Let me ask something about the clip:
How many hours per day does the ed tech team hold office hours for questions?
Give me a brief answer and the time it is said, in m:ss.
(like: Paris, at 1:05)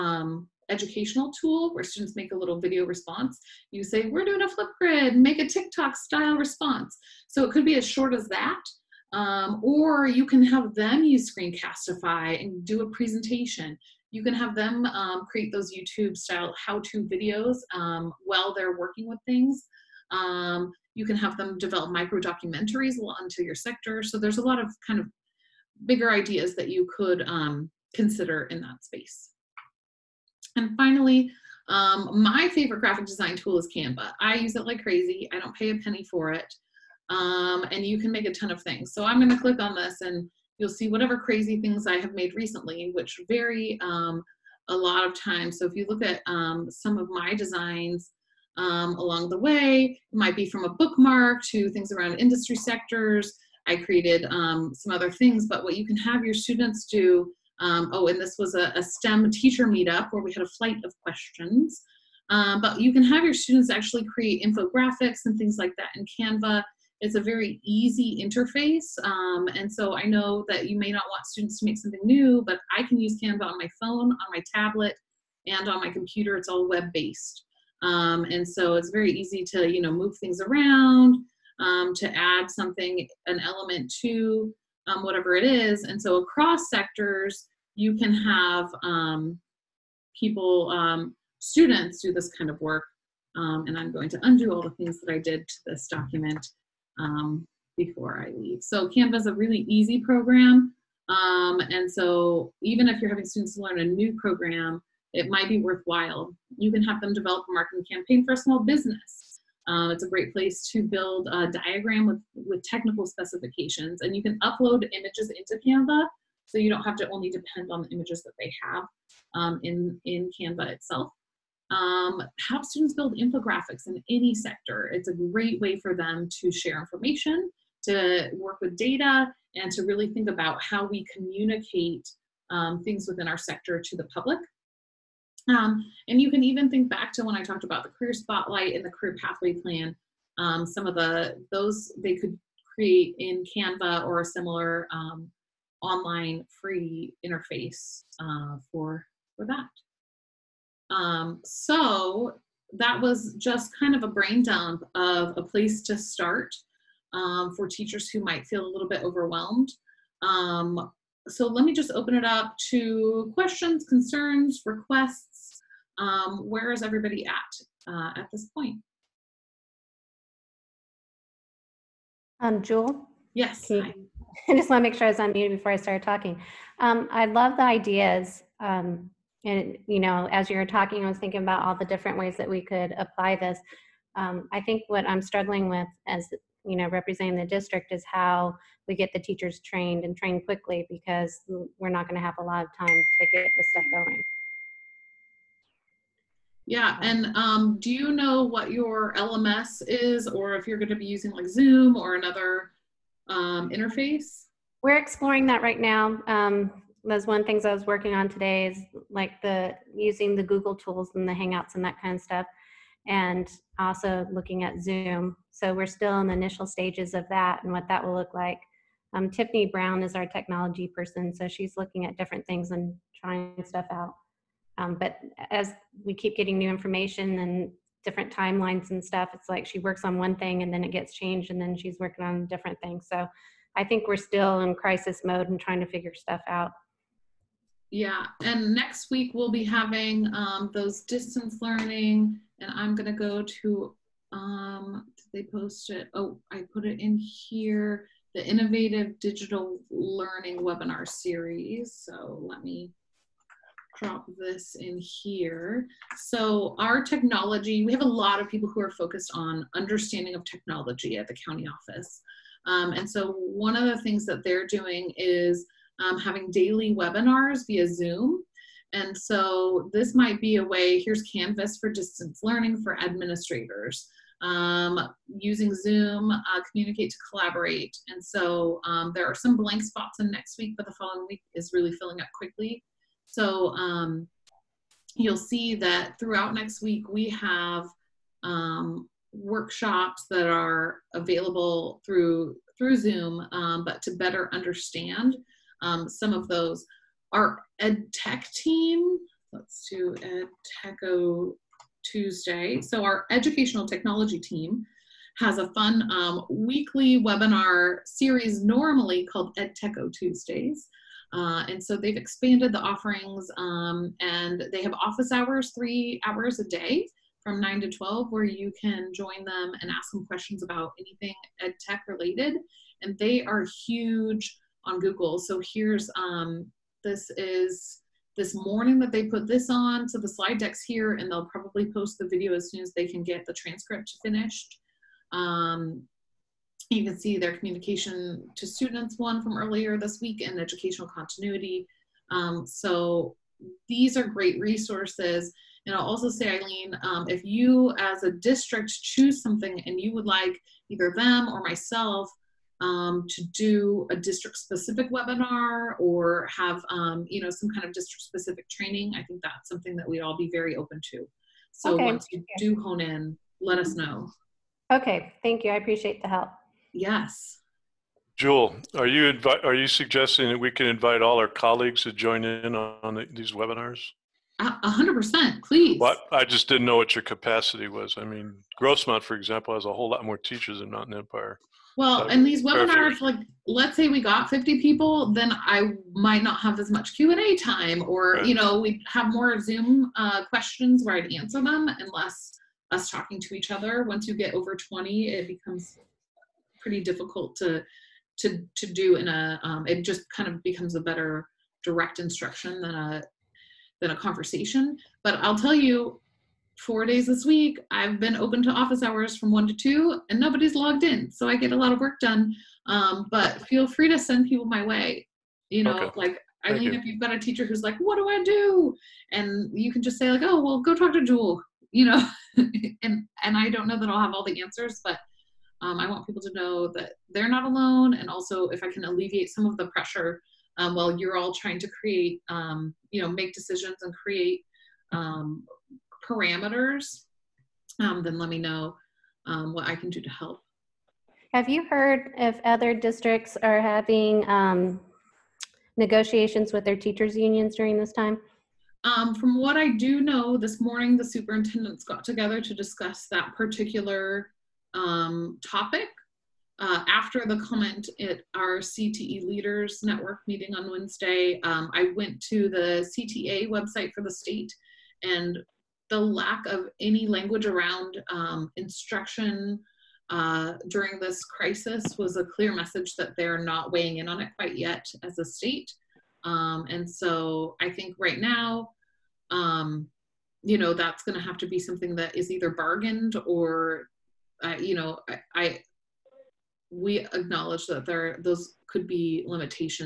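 3, at 5:15.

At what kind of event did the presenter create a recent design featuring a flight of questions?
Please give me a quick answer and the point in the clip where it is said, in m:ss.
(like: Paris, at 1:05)
STEM teacher meetup, at 0:58.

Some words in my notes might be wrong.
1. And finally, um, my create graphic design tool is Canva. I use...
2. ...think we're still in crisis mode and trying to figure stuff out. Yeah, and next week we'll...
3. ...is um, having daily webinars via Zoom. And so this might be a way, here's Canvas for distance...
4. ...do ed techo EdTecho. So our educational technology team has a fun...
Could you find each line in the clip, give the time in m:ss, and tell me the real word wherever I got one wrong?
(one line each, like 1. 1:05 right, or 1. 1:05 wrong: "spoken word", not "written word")
1. 0:30 wrong: "favorite", not "create"
2. 3:53 right
3. 4:25 right
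4. 4:59 wrong: "Tuesday", not "EdTecho".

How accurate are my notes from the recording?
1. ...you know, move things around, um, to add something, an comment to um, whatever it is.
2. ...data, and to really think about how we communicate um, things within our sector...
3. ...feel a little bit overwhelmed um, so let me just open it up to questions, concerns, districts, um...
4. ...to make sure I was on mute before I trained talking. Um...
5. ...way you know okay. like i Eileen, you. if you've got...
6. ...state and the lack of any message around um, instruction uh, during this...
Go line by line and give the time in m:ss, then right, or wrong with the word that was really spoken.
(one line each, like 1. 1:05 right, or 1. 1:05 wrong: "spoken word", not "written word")
1. 1:19 wrong: "element", not "comment"
2. 2:08 right
3. 2:38 wrong: "requests", not "districts"
4. 2:54 wrong: "started", not "trained"
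5. 6:54 right
6. 7:44 wrong: "language", not "message".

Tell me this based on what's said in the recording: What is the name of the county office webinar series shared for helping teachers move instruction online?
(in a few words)
Innovative Digital Learning Webinar Series.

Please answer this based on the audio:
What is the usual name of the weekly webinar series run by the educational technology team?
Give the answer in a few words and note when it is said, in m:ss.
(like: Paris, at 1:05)
EdTecho Tuesdays, at 5:09.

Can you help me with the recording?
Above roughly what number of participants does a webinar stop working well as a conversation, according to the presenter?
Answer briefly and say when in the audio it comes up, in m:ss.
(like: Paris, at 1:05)
20, at 6:34.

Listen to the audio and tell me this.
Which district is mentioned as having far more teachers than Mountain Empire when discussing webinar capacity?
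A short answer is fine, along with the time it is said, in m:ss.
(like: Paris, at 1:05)
Grossmont, at 6:18.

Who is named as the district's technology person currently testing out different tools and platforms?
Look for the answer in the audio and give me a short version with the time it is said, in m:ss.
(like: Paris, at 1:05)
Tiffany Brown, at 3:39.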